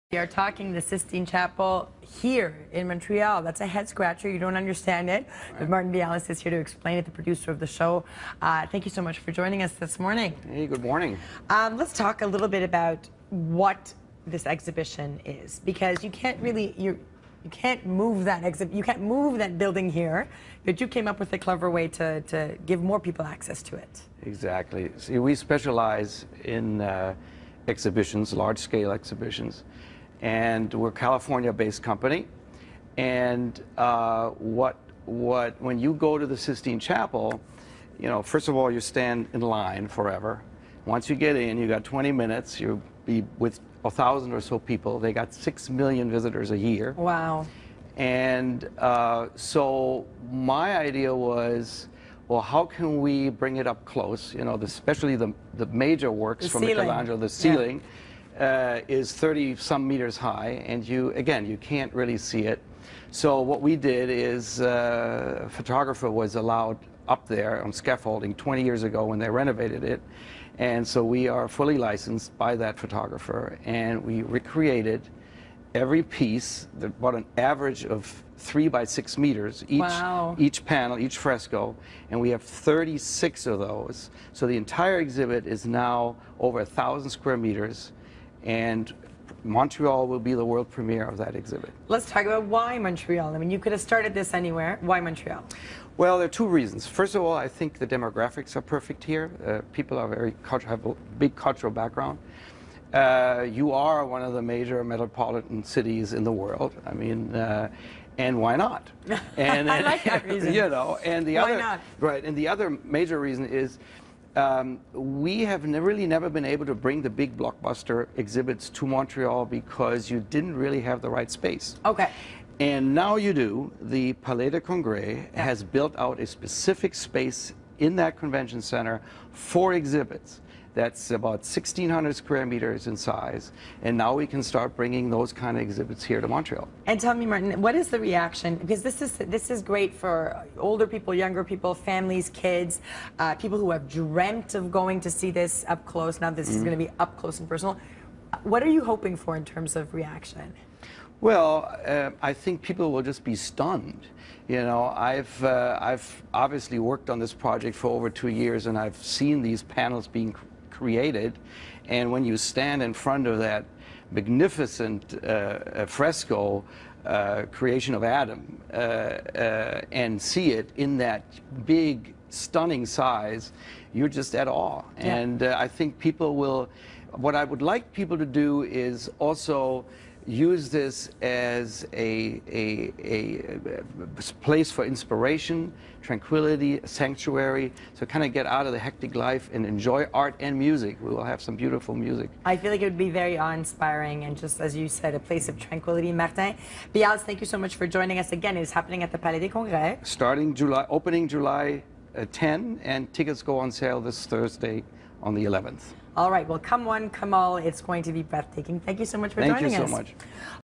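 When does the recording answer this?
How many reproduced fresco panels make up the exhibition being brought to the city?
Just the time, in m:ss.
1:22.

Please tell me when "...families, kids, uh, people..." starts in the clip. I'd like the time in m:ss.
2:21.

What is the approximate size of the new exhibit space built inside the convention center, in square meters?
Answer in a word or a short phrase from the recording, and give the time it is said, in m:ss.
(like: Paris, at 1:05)
1,600 square meters, at 2:11.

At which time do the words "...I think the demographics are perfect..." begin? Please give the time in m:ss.
1:37.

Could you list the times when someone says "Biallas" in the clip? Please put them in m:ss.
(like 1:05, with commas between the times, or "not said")
0:05, 3:16.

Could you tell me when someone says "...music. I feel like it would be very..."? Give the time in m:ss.
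3:11.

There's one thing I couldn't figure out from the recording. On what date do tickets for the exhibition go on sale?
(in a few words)
Thursday the 11th.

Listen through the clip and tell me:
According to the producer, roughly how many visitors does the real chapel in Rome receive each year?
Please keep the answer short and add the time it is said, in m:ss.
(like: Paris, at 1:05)
6 million, at 0:45.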